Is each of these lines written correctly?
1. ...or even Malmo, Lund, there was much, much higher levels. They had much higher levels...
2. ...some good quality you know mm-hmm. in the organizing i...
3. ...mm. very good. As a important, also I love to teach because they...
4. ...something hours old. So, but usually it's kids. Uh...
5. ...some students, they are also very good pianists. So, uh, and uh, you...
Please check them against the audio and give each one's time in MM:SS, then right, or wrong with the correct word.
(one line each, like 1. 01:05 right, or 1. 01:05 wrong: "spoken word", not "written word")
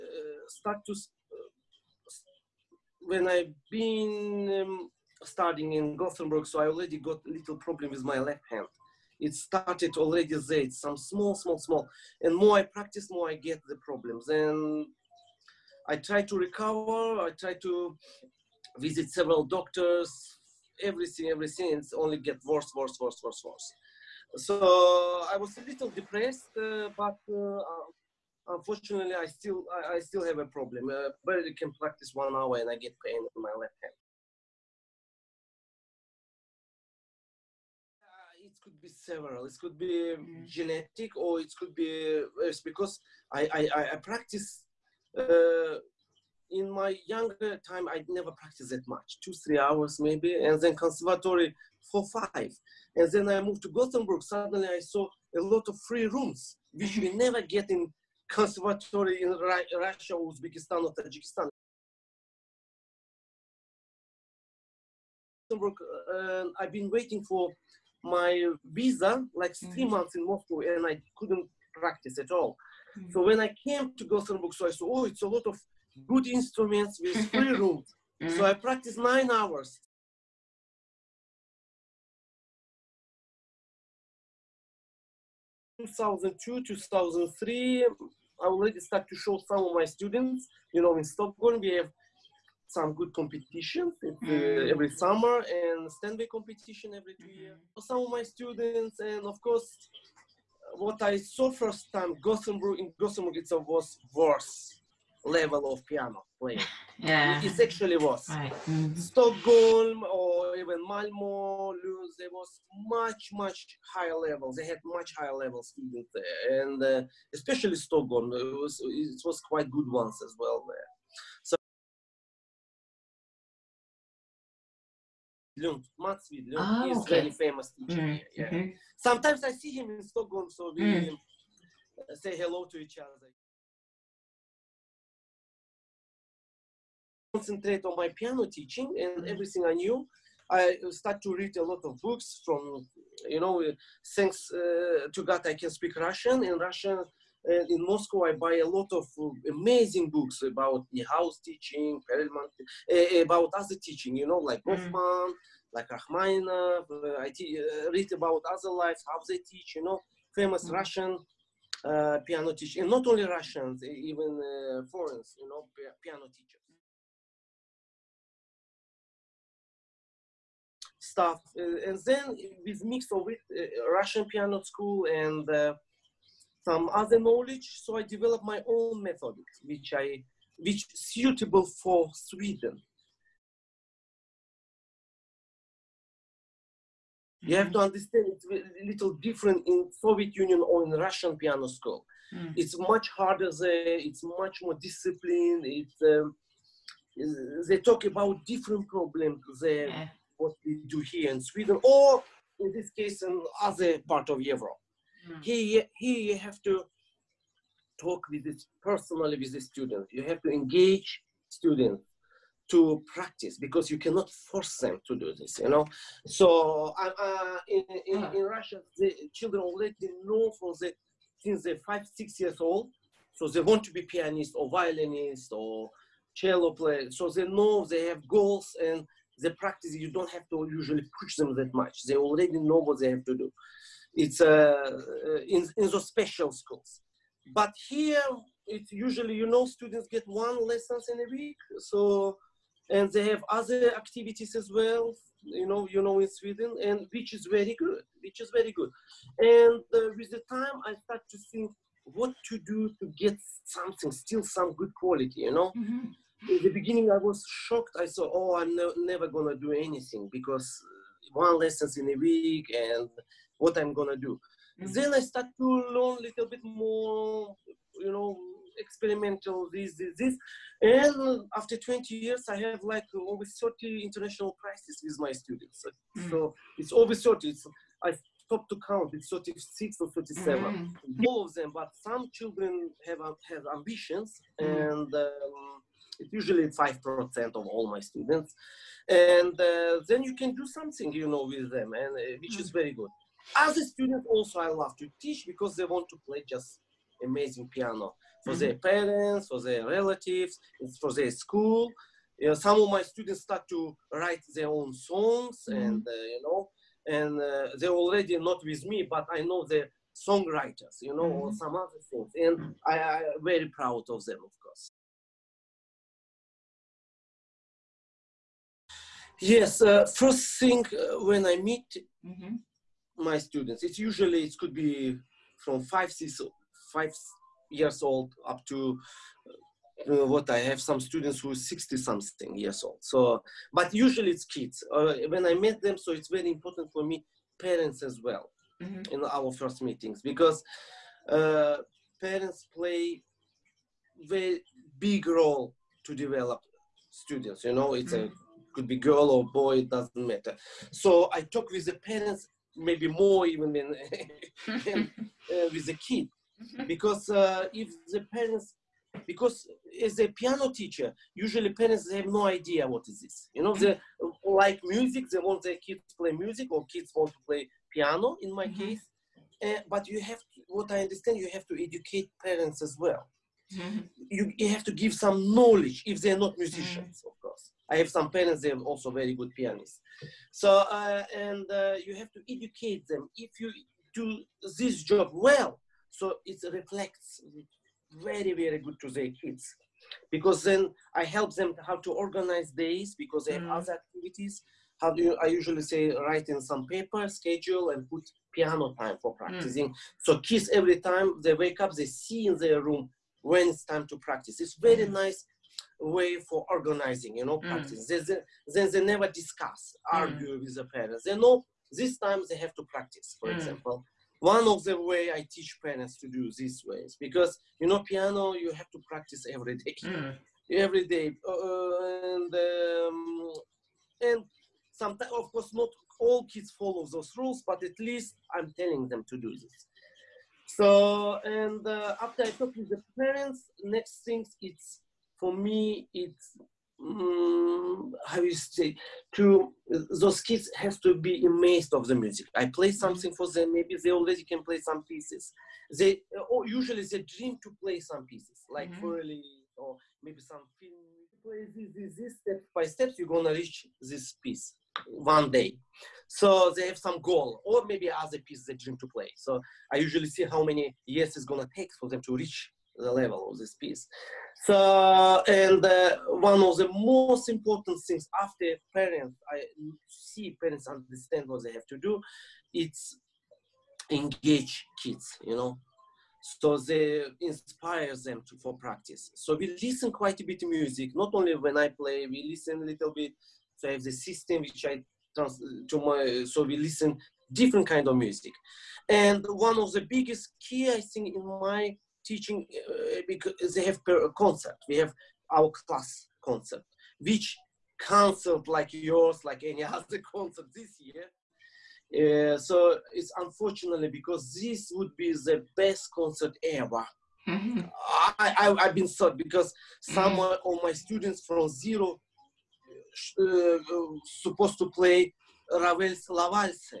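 1. 01:50 right
2. 04:14 wrong: "beginning", not "organizing"
3. 04:52 wrong: "student", not "important"
4. 05:31 wrong: "years", not "hours"
5. 06:18 wrong: "parents", not "students".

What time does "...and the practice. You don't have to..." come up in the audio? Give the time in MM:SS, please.
03:48.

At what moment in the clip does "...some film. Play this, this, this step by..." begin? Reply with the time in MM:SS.
07:30.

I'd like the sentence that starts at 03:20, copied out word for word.
what we do here in Sweden, or in this case, in other part of Europe.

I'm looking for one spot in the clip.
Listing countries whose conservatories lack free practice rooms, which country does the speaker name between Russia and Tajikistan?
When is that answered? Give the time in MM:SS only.
01:00.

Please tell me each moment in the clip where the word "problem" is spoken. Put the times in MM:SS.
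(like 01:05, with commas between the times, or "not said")
00:07, 00:13, 00:30, 03:18.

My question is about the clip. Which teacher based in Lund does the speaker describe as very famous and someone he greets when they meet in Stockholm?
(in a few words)
Mats Widlund.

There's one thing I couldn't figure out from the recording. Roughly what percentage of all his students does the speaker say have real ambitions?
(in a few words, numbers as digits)
5%.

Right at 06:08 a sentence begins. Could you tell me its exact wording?
case uh, but you have to, what i understand you have to educate parents as well mm-hmm.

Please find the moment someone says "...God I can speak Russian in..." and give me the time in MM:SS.
02:25.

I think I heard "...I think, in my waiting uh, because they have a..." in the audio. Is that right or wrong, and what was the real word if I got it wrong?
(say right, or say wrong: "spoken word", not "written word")
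wrong: "teaching", not "waiting".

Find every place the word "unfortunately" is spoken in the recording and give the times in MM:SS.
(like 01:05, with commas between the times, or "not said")
00:28, 08:23.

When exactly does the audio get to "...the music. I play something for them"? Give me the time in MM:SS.
07:22.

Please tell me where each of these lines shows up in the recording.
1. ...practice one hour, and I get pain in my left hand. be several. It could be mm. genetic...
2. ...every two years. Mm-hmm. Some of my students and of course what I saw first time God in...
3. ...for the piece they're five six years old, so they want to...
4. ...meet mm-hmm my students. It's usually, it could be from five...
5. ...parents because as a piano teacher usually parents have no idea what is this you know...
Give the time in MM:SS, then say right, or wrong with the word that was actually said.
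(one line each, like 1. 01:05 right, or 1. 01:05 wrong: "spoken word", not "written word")
1. 00:31 right
2. 01:36 wrong: "Gothenburg", not "God"
3. 03:40 wrong: "since", not "piece"
4. 05:21 right
5. 05:58 right.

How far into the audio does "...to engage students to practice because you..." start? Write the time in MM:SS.
03:30.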